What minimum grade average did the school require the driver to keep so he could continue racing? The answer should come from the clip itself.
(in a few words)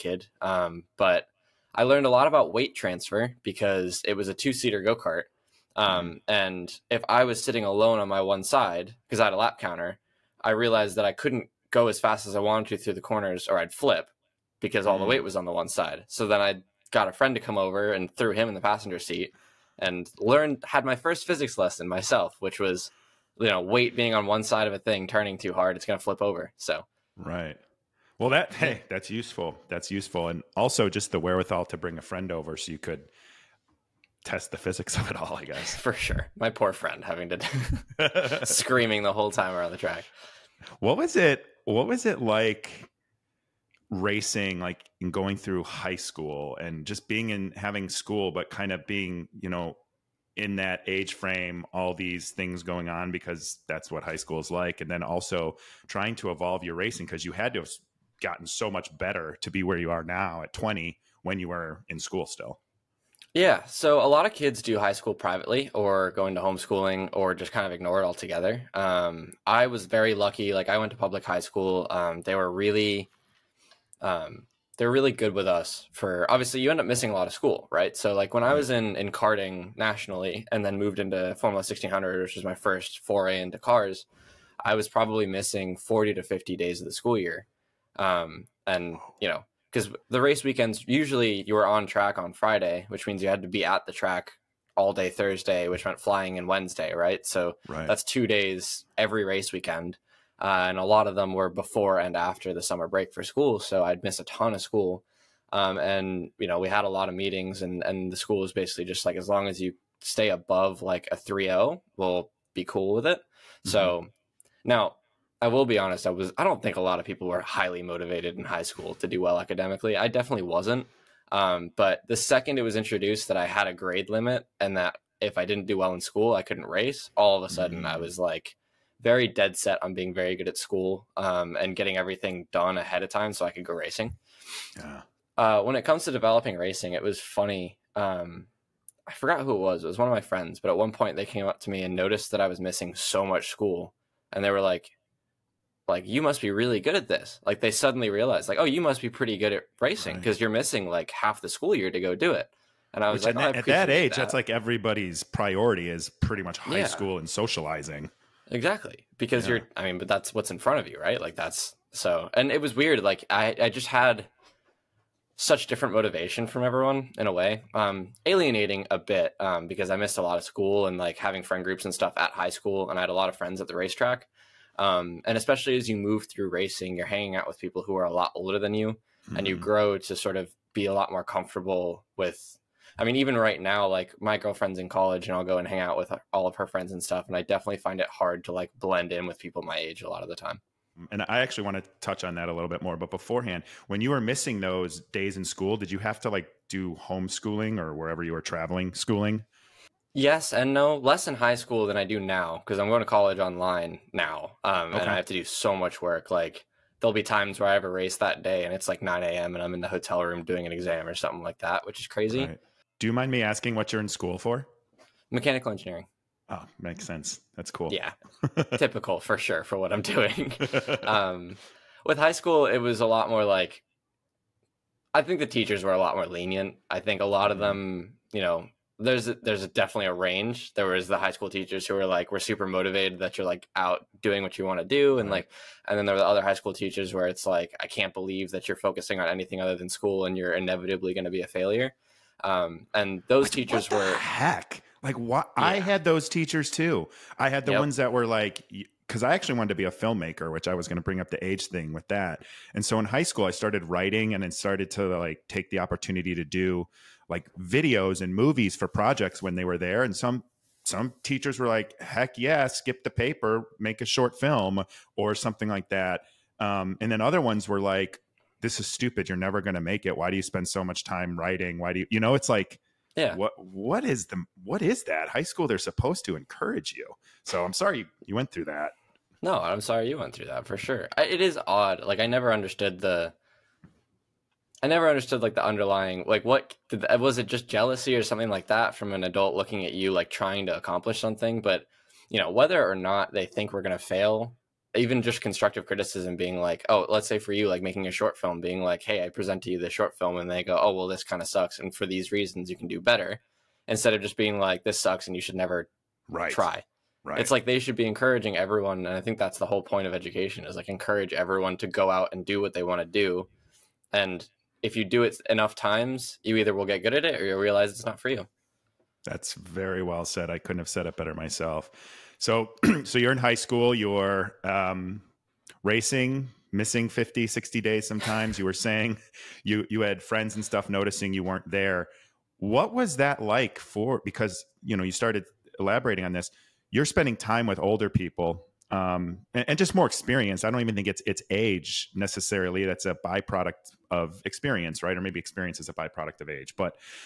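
3.0.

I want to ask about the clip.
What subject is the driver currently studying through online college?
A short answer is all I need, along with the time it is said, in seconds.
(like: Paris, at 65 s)
Mechanical engineering, at 215 s.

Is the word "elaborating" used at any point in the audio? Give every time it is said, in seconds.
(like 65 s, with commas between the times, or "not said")
335 s.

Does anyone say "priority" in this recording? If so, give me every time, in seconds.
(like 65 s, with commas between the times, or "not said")
155 s.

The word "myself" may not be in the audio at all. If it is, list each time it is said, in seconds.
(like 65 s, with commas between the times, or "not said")
21 s, 321 s.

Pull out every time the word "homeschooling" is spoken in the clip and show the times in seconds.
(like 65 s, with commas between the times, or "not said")
66 s, 196 s.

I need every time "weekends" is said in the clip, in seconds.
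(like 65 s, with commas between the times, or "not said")
90 s, 99 s.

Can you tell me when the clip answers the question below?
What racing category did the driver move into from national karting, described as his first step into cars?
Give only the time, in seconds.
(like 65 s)
81 s.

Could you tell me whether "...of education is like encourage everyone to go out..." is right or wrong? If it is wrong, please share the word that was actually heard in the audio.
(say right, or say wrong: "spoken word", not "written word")
right.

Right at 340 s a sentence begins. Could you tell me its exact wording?
I don't even think it's it's age necessarily.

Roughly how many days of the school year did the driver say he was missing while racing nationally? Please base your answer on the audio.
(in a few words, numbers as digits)
40 to 50 days.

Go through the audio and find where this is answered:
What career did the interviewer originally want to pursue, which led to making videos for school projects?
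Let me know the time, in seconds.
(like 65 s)
249 s.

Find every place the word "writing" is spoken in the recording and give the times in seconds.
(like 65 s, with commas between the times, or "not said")
253 s, 271 s.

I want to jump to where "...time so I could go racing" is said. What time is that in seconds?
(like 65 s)
133 s.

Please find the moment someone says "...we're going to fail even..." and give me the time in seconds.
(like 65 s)
293 s.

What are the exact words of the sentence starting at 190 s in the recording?
Mm, and I actually want to touch on that a little bit more.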